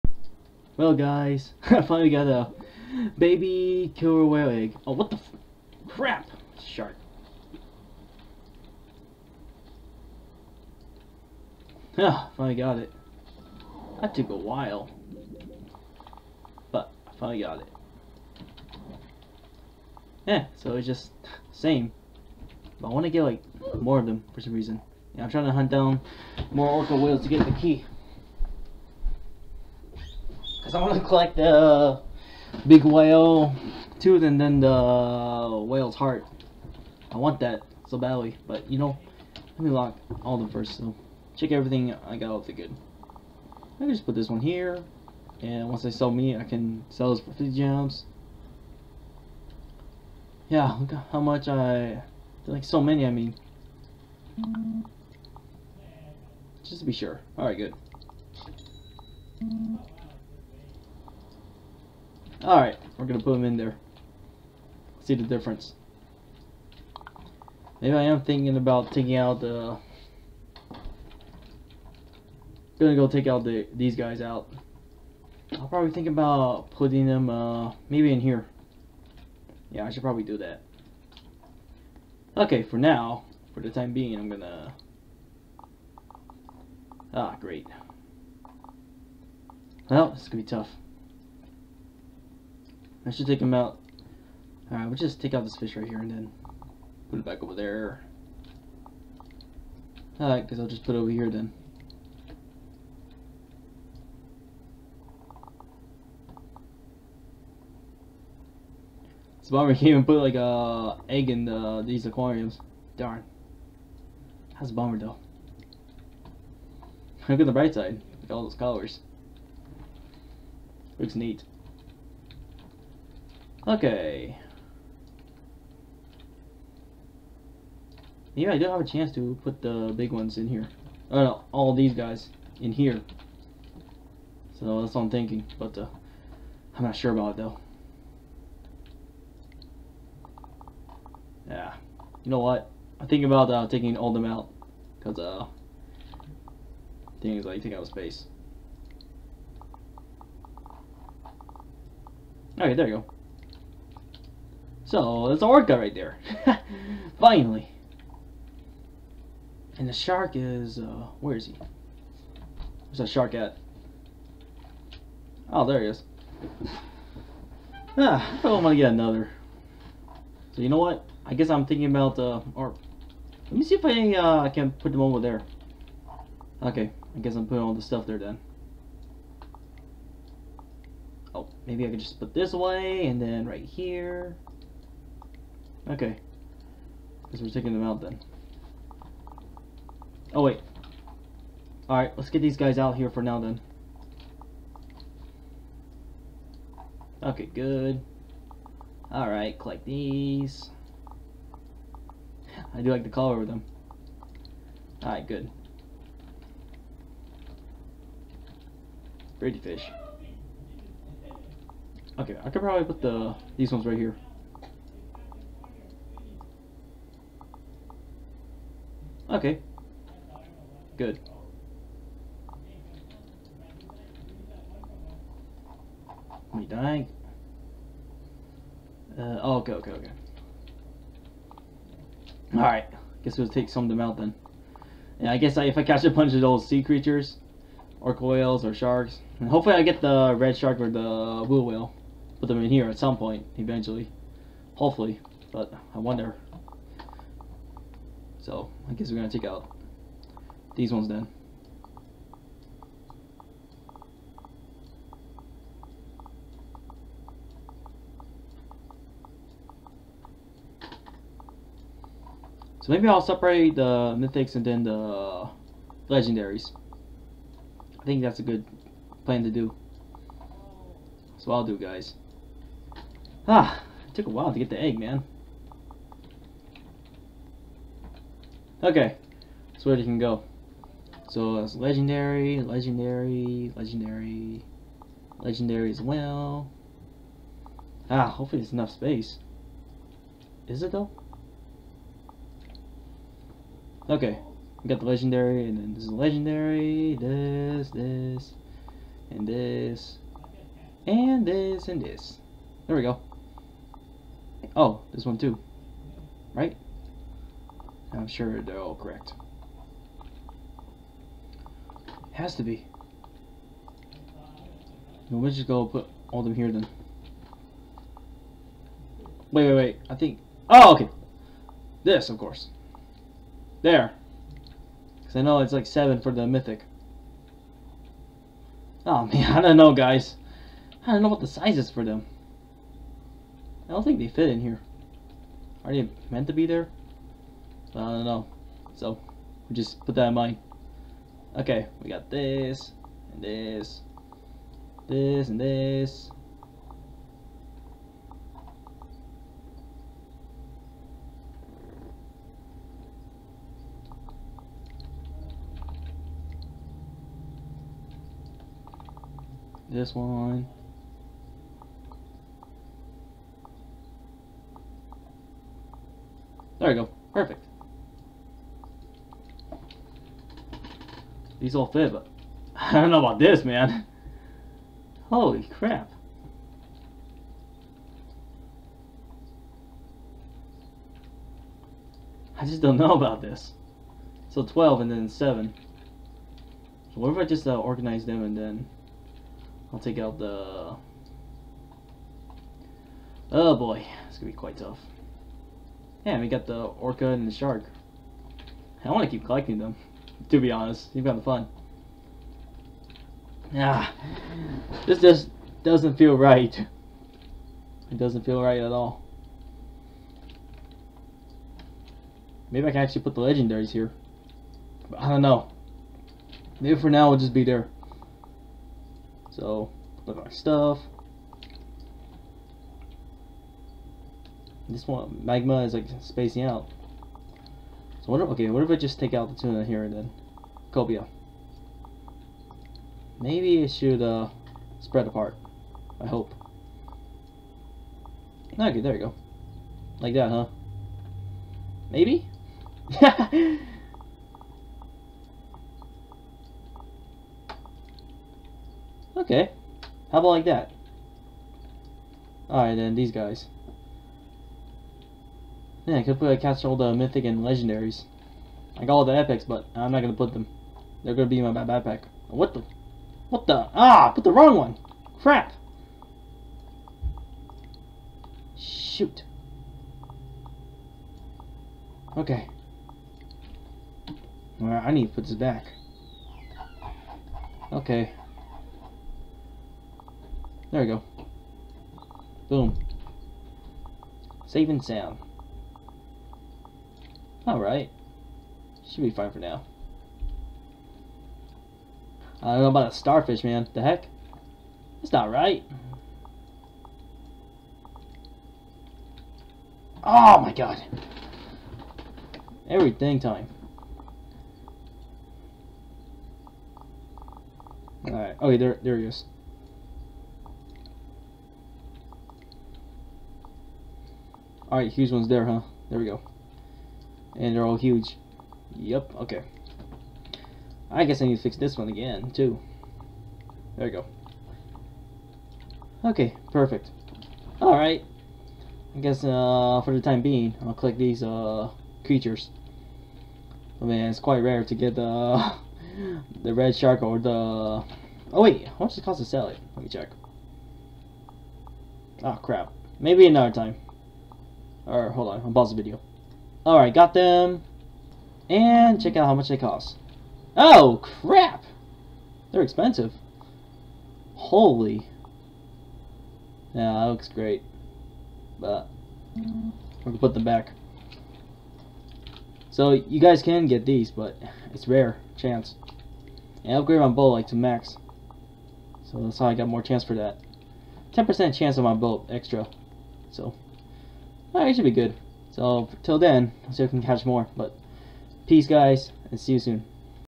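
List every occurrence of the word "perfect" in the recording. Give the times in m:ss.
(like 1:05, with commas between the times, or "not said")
6:07, 8:46.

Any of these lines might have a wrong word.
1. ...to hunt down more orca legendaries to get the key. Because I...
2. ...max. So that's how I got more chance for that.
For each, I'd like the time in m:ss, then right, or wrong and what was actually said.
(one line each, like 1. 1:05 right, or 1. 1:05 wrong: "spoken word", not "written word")
1. 0:25 wrong: "whales", not "legendaries"
2. 9:27 right.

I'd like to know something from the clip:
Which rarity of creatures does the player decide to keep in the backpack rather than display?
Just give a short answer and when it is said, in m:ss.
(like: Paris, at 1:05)
Epics, at 7:39.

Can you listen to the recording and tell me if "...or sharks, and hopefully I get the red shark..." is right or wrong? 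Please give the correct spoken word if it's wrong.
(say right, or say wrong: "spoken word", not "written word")
right.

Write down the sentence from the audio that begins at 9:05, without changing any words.
Or hold on, I'll pause the video.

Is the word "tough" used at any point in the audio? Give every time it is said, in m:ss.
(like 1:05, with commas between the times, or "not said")
1:30, 6:34.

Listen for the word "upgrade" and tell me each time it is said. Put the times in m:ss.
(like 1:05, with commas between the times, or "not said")
9:26.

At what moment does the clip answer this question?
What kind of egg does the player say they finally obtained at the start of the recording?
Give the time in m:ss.
0:03.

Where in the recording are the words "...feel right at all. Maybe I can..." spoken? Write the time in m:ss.
6:48.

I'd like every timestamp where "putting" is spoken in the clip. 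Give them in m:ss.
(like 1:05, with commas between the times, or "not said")
1:16, 2:57.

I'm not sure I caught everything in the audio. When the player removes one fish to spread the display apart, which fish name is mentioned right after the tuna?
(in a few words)
Cobia.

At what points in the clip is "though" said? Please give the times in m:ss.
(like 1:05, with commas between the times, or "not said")
1:54, 2:17, 4:50.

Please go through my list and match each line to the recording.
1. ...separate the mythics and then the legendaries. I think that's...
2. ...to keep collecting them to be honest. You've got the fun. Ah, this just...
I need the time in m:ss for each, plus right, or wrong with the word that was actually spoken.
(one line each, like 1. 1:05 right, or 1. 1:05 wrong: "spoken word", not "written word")
1. 4:23 right
2. 6:39 right.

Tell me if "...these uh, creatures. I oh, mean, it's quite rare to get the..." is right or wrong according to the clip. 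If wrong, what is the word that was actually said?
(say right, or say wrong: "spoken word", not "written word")
right.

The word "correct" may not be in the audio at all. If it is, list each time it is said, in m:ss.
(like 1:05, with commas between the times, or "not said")
5:08.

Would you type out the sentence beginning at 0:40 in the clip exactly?
So, check everything I got off the good.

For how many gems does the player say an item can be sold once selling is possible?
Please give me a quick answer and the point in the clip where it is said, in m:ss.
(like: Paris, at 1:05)
50 gems, at 0:47.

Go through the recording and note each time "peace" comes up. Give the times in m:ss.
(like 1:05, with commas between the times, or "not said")
9:38.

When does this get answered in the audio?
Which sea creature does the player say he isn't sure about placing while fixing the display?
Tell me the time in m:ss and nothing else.
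8:13.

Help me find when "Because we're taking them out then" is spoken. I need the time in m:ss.
3:07.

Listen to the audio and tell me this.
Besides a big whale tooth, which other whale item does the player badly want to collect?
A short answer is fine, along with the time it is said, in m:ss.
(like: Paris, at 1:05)
Whale's heart, at 0:34.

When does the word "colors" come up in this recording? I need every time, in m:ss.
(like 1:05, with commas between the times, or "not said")
1:58, 3:23.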